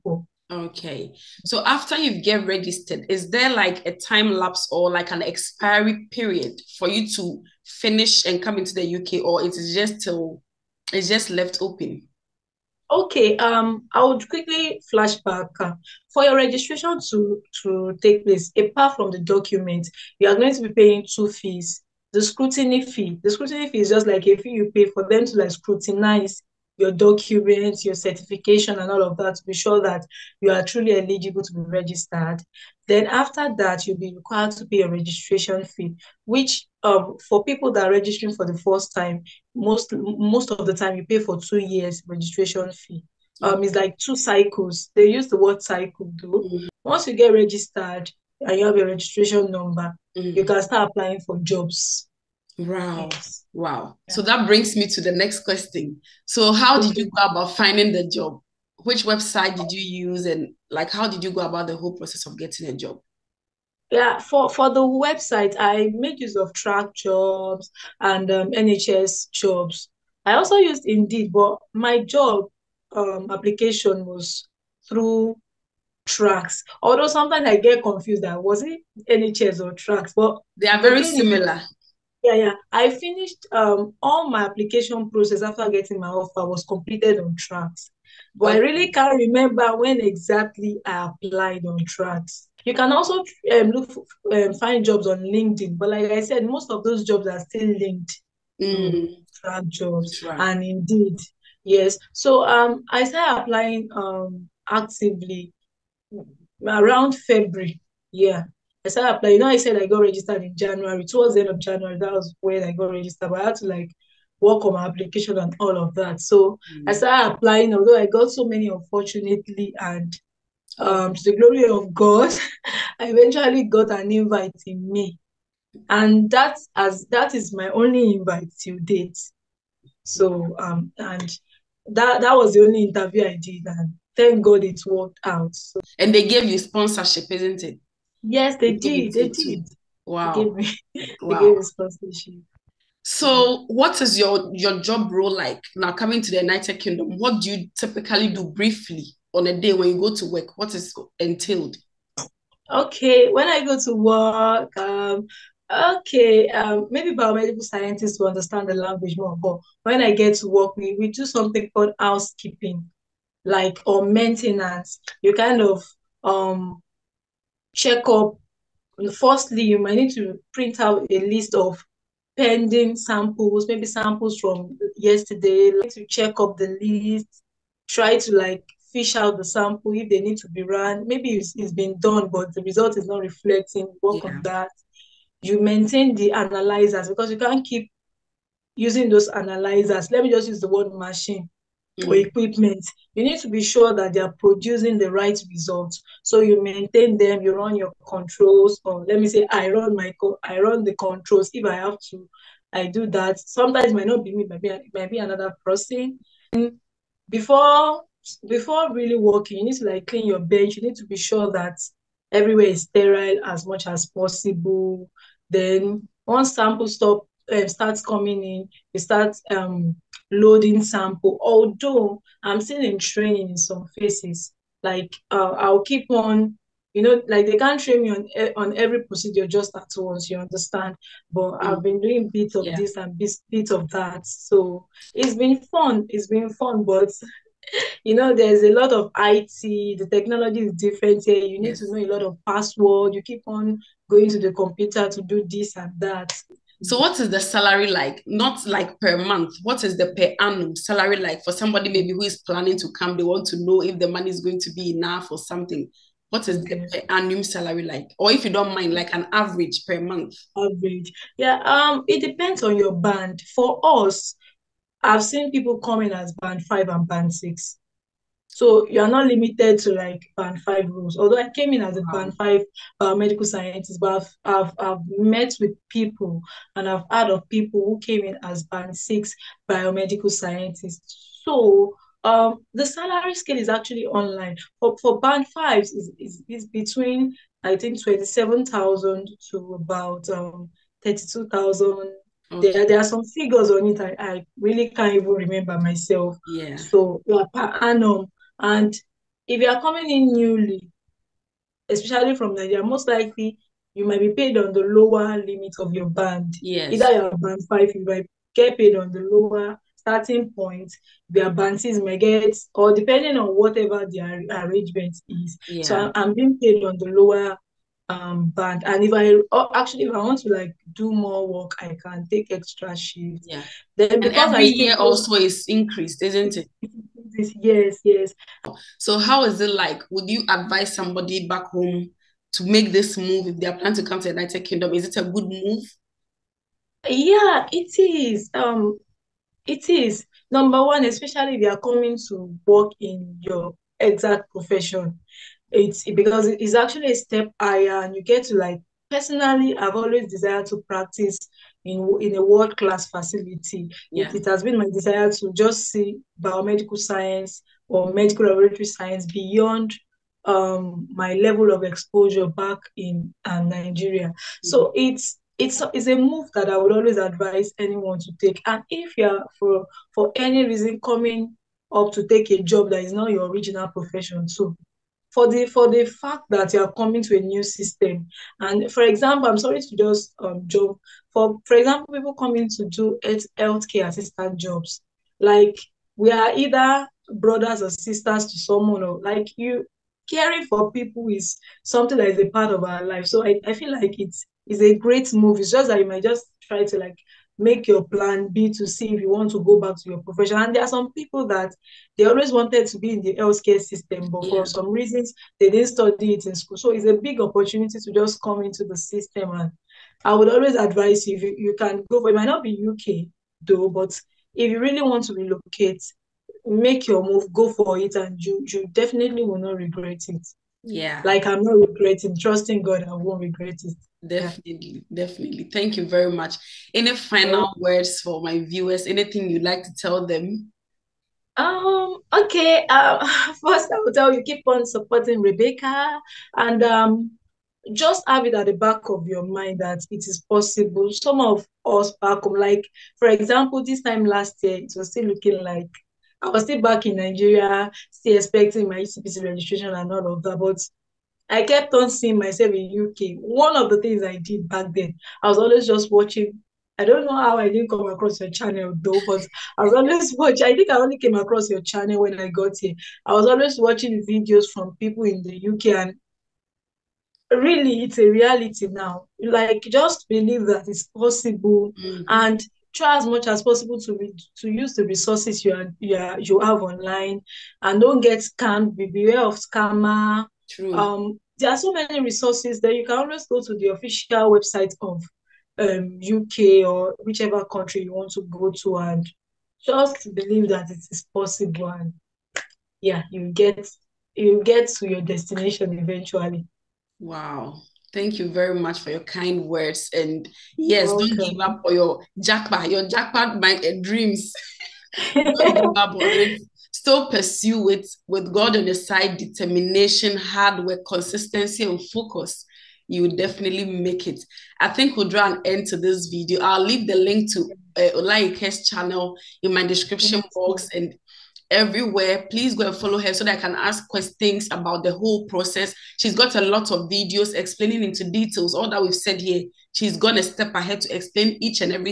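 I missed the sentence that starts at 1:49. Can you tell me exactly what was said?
You know, I said I got registered in January, towards the end of January, that was when I got registered.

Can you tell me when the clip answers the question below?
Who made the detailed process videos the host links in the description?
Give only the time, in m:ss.
8:38.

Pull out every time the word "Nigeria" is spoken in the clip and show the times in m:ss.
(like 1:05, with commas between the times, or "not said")
5:02, 6:03, 7:27.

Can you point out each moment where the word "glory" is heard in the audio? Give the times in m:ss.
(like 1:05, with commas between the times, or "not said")
2:01.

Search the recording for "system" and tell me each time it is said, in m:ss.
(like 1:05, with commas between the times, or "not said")
6:17, 6:43, 6:48.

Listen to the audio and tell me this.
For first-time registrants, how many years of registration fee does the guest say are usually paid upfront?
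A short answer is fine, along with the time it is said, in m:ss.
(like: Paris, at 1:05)
2 years, at 0:41.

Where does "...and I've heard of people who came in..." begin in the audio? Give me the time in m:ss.
4:36.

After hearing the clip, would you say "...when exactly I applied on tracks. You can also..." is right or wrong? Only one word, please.
right.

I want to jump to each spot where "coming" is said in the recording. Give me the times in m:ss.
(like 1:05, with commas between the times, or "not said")
2:25, 3:38, 4:25, 4:59, 5:41, 6:11, 6:16, 6:22.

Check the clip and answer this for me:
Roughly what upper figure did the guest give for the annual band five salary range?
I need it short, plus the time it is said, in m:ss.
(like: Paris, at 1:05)
32,000, at 4:51.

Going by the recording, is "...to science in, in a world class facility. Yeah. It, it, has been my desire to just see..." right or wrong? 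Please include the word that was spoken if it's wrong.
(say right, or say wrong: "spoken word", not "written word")
wrong: "practice", not "science".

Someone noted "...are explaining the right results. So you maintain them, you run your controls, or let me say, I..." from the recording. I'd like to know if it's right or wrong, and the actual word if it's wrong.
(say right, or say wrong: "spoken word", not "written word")
wrong: "producing", not "explaining".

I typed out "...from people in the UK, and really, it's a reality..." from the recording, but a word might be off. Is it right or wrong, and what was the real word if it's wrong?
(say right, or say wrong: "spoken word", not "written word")
right.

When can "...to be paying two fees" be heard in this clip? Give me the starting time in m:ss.
0:20.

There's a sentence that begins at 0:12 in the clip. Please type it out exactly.
Okay, um, I would quickly flash back.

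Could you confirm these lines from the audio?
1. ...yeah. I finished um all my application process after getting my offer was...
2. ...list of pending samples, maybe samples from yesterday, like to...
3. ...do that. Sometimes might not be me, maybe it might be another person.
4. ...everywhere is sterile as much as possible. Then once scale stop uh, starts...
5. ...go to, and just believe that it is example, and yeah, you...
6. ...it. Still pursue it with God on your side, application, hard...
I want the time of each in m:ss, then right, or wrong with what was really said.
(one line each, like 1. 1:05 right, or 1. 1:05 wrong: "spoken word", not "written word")
1. 1:22 right
2. 2:51 right
3. 3:22 right
4. 3:32 wrong: "sample", not "scale"
5. 8:08 wrong: "possible", not "example"
6. 8:26 wrong: "determination", not "application".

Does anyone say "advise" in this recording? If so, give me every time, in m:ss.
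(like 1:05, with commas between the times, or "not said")
5:30, 6:07, 6:50.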